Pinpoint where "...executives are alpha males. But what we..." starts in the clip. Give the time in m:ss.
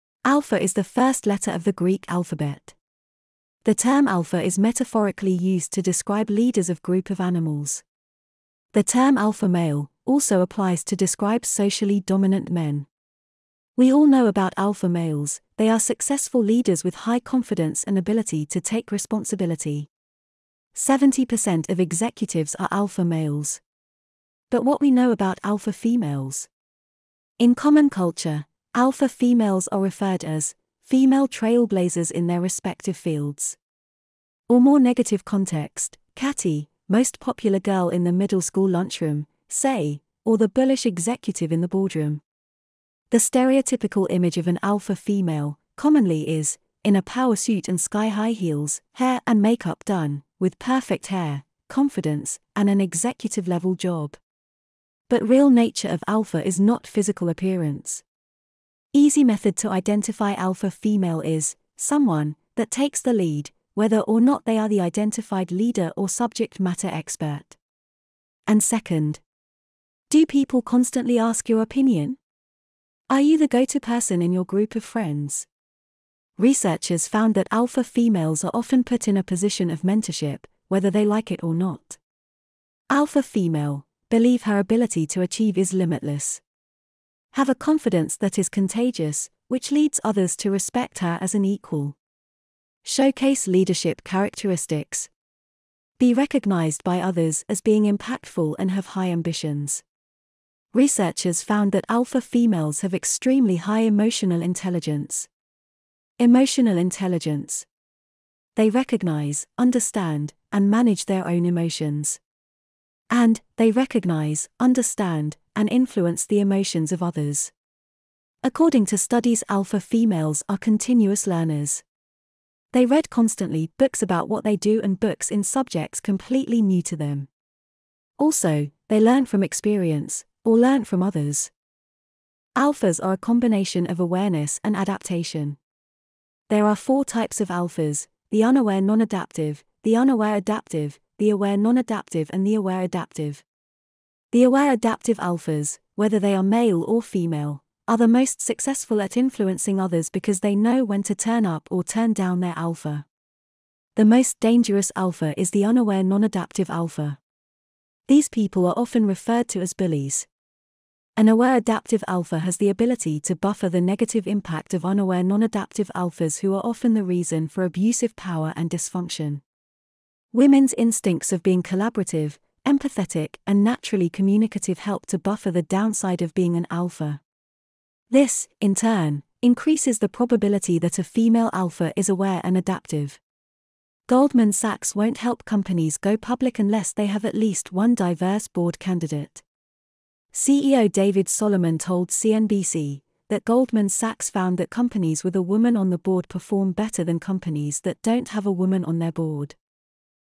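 0:21.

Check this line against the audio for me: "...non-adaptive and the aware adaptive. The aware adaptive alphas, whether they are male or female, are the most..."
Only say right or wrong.
right.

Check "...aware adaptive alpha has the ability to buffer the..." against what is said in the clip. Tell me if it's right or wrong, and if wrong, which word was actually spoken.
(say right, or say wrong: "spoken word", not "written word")
right.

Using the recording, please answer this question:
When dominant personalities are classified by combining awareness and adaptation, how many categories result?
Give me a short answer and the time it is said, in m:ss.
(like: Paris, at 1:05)
4, at 2:16.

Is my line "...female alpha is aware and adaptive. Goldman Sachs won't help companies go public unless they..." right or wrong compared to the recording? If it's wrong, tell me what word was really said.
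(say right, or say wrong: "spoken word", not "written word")
right.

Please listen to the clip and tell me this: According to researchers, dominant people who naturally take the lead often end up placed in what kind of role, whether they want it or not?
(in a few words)
mentorship.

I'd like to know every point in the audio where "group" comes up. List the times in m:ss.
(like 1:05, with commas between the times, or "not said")
0:06, 1:14.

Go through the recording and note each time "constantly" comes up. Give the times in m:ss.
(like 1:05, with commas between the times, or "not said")
1:10, 2:03.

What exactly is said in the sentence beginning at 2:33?
The most dangerous alpha is the unaware non adaptive alpha.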